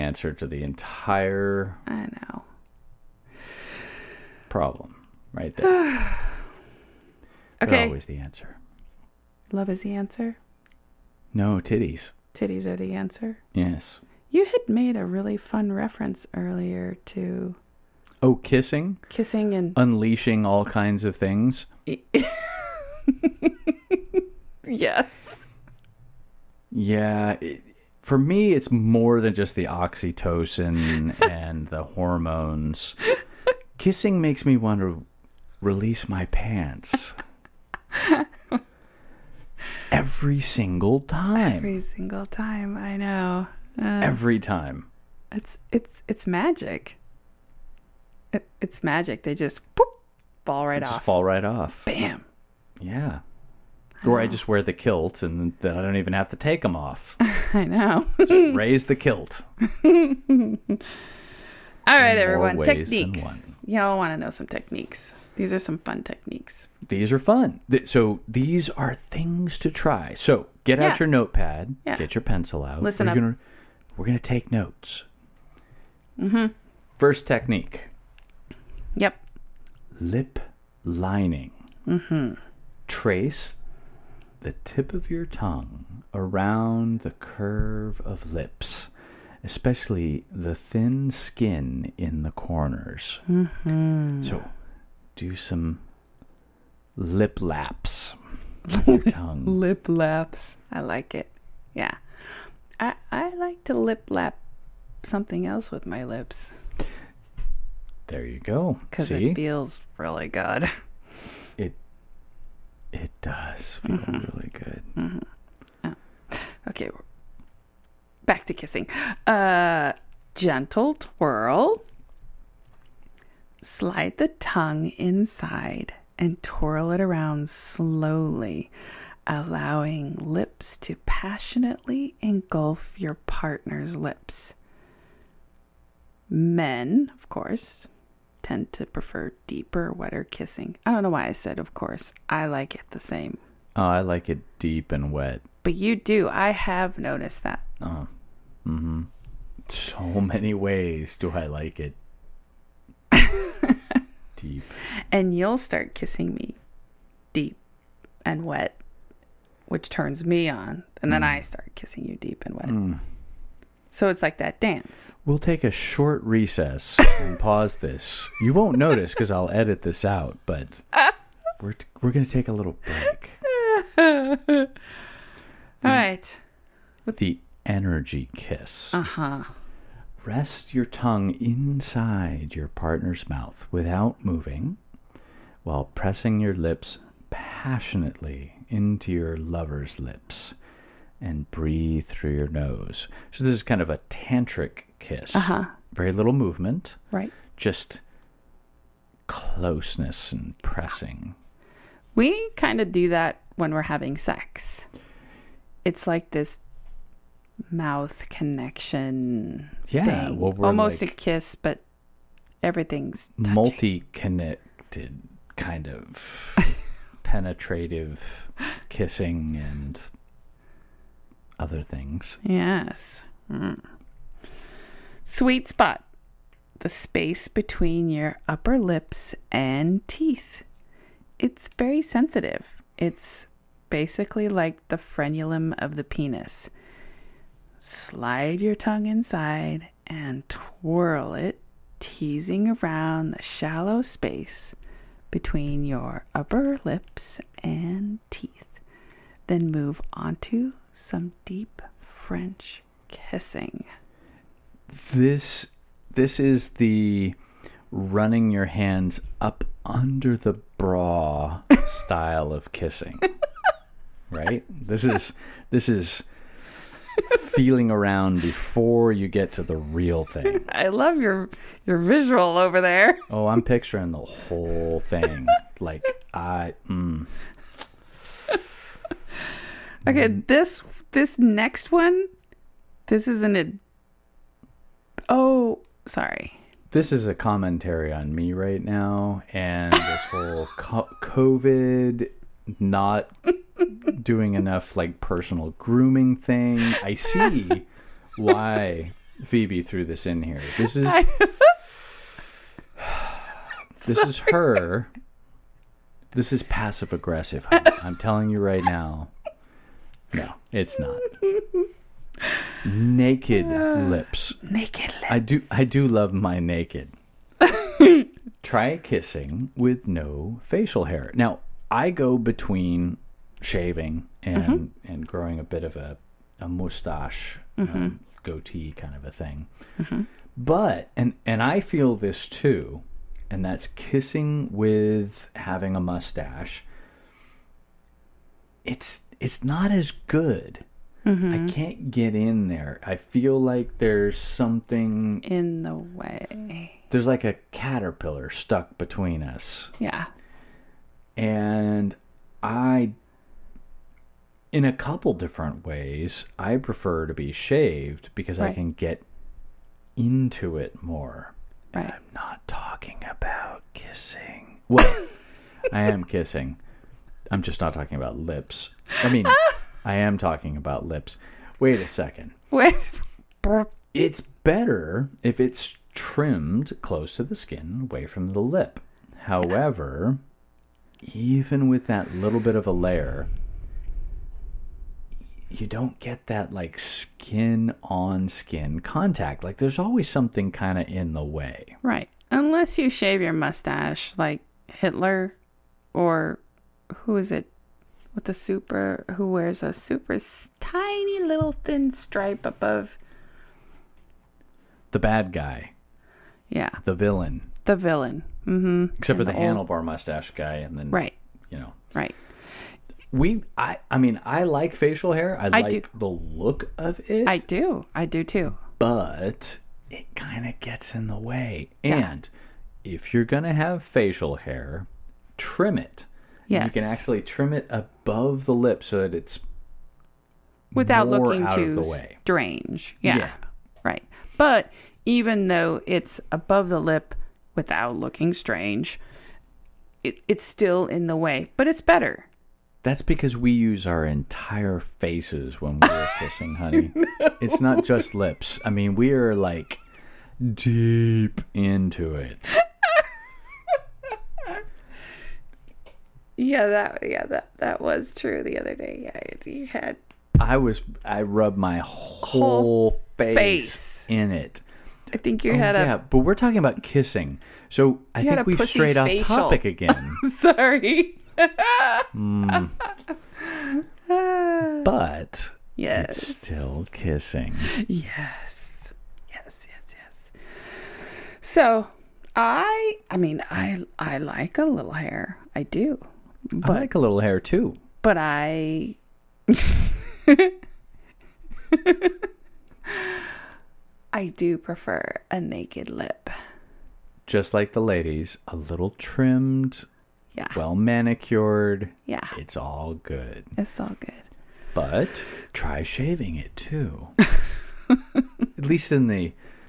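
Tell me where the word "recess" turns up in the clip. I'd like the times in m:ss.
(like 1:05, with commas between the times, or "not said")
2:46.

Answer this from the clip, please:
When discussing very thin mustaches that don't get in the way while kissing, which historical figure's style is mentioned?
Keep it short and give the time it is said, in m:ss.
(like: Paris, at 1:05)
Hitler, at 6:34.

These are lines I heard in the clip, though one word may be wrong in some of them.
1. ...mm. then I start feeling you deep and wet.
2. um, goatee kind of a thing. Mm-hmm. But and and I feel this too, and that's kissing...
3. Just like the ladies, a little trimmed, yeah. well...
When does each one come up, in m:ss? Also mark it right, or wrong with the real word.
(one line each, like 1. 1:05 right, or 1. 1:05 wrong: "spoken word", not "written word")
1. 2:41 wrong: "kissing", not "feeling"
2. 5:27 right
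3. 8:17 right.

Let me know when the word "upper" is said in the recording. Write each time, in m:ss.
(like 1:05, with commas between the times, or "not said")
3:48, 4:06.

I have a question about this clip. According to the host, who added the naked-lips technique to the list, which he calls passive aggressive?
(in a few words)
Phoebe.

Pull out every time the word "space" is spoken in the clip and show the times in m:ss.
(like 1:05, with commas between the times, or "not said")
3:46, 4:04.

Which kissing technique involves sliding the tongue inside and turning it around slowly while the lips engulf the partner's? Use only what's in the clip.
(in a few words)
Gentle twirl.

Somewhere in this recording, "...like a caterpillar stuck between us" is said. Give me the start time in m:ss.
5:47.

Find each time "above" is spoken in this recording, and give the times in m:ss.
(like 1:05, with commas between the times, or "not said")
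6:42, 7:07, 7:16.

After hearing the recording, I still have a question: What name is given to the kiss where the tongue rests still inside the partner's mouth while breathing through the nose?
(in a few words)
Energy kiss.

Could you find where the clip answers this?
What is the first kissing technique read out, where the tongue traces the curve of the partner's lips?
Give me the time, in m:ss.
1:19.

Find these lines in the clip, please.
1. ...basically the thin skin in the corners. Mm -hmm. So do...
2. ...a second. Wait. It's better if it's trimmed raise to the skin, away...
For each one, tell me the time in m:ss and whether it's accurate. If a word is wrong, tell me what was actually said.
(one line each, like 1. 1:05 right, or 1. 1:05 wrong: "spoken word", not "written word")
1. 1:29 wrong: "especially", not "basically"
2. 6:11 wrong: "close", not "raise".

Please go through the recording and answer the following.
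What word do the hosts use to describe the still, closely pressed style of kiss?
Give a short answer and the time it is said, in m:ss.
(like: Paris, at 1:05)
Tantric, at 3:14.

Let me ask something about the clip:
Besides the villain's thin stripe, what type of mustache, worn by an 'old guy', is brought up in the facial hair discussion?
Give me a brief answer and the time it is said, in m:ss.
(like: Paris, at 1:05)
Handlebar mustache, at 6:49.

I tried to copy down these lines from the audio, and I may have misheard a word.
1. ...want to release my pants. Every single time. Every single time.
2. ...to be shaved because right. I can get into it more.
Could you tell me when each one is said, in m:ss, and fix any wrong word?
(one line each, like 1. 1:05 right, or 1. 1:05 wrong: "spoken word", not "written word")
1. 0:34 right
2. 5:57 right.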